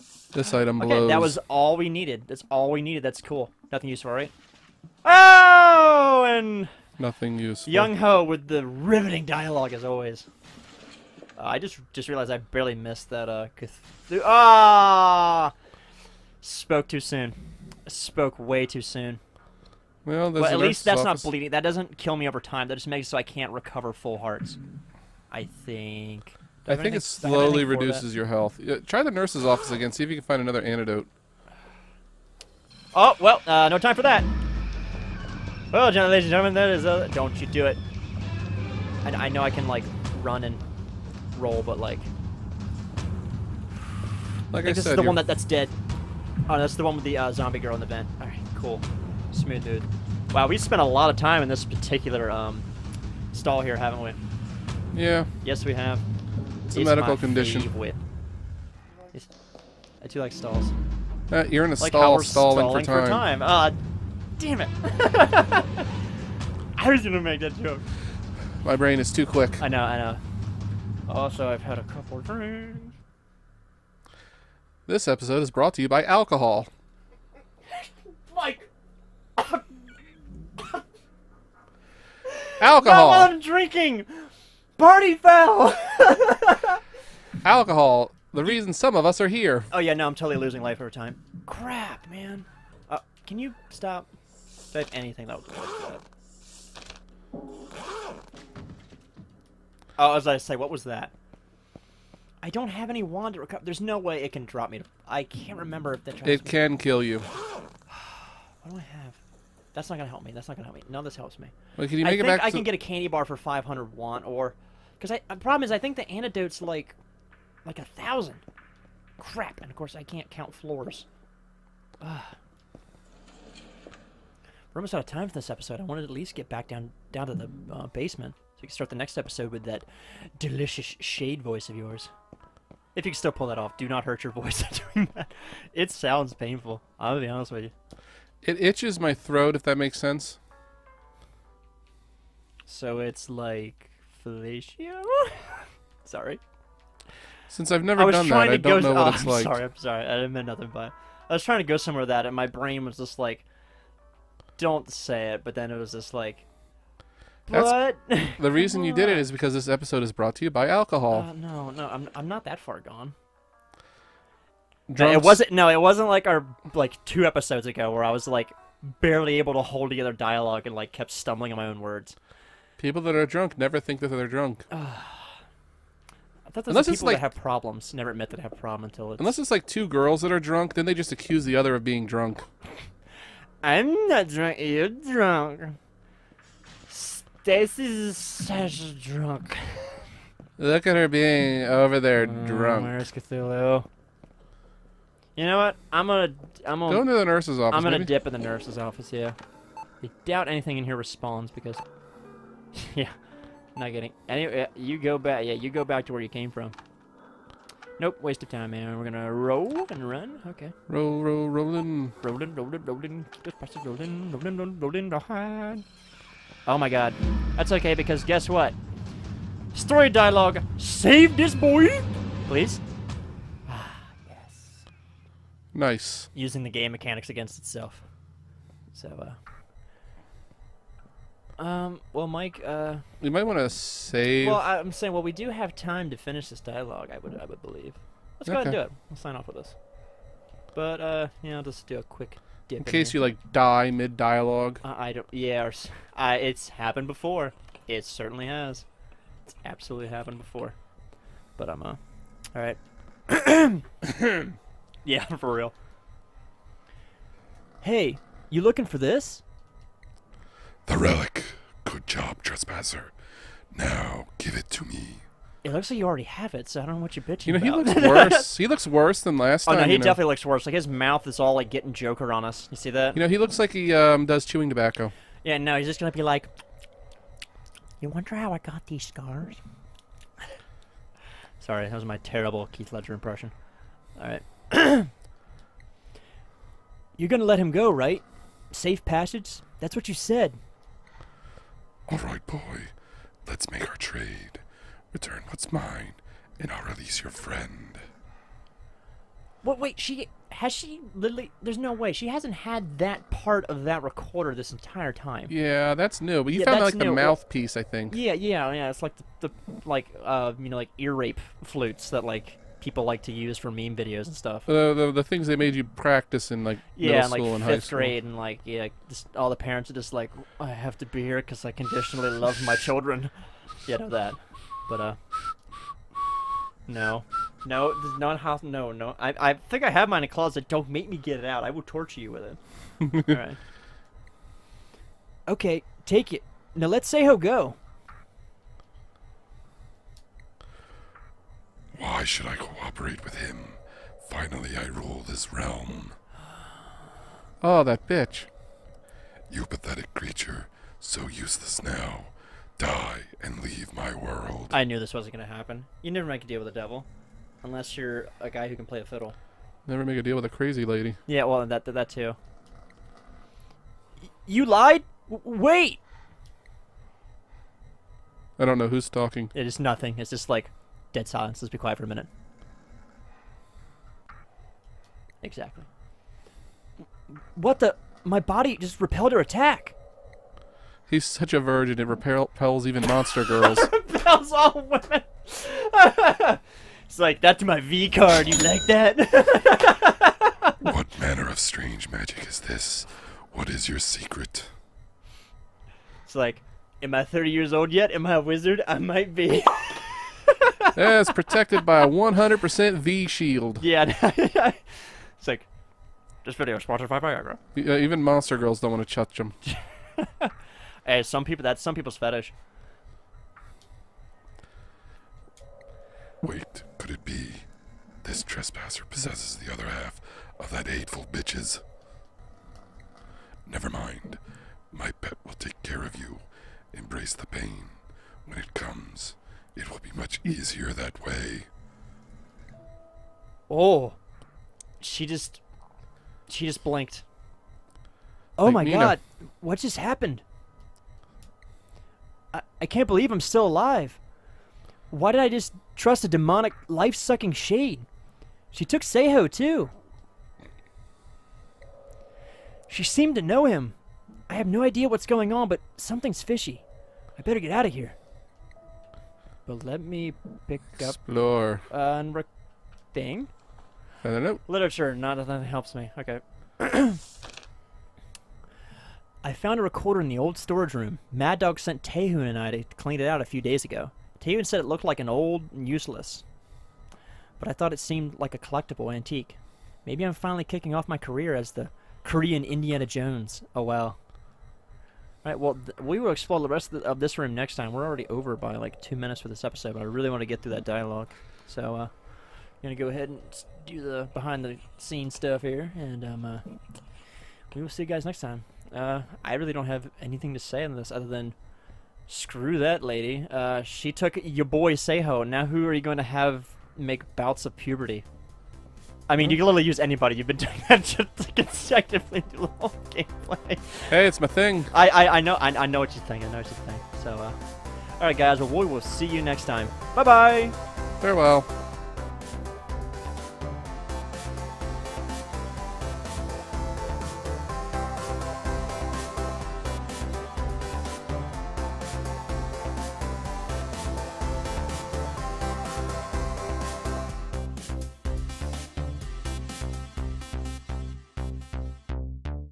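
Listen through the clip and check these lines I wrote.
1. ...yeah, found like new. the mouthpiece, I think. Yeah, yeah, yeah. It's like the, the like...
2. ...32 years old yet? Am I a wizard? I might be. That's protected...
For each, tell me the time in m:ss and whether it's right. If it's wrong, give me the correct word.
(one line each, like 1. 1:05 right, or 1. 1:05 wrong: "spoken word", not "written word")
1. 5:06 right
2. 6:37 wrong: "30", not "32".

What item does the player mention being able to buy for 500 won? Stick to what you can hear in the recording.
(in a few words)
Candy bar.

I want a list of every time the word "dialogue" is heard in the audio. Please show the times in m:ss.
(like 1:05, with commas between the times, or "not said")
0:09, 2:50, 3:40, 3:56, 4:04, 8:10.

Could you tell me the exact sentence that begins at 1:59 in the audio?
Crap, and of course I can't count floors.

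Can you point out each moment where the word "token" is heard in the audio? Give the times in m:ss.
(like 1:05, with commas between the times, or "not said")
not said.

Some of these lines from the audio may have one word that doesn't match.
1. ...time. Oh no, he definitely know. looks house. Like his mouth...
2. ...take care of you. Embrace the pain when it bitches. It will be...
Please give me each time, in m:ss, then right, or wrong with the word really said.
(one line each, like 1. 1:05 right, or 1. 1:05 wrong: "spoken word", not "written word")
1. 4:29 wrong: "worse", not "house"
2. 7:05 wrong: "comes", not "bitches".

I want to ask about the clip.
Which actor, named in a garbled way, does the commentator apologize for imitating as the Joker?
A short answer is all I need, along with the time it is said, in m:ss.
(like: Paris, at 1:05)
Keith Ledger, at 4:42.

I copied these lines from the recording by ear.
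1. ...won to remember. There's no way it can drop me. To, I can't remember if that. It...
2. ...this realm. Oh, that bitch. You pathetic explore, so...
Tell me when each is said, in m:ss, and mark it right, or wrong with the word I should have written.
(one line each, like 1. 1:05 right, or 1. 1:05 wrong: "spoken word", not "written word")
1. 1:43 wrong: "recover", not "remember"
2. 5:45 wrong: "creature", not "explore".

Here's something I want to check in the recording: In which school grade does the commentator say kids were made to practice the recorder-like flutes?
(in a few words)
Fifth grade.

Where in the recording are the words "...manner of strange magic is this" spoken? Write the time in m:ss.
6:31.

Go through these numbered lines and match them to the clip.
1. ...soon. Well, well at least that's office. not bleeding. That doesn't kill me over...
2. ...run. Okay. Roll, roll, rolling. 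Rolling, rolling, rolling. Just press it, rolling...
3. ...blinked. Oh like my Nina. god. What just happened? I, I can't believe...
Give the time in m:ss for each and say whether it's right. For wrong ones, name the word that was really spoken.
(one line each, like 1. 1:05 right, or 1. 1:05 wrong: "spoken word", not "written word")
1. 0:18 right
2. 3:30 right
3. 7:16 right.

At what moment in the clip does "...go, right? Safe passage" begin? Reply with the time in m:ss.
4:47.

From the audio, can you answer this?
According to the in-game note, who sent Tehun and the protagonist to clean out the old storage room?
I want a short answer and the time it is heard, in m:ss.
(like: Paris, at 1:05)
Mad Dog, at 7:51.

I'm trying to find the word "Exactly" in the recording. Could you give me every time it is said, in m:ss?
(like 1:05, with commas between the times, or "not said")
6:15.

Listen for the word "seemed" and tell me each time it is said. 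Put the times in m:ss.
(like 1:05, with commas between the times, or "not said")
7:33, 7:57.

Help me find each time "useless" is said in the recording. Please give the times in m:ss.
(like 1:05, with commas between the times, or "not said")
5:51, 7:55.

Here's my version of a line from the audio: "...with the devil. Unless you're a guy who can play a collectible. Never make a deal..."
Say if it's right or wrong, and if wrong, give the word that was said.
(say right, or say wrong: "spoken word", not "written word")
wrong: "fiddle", not "collectible".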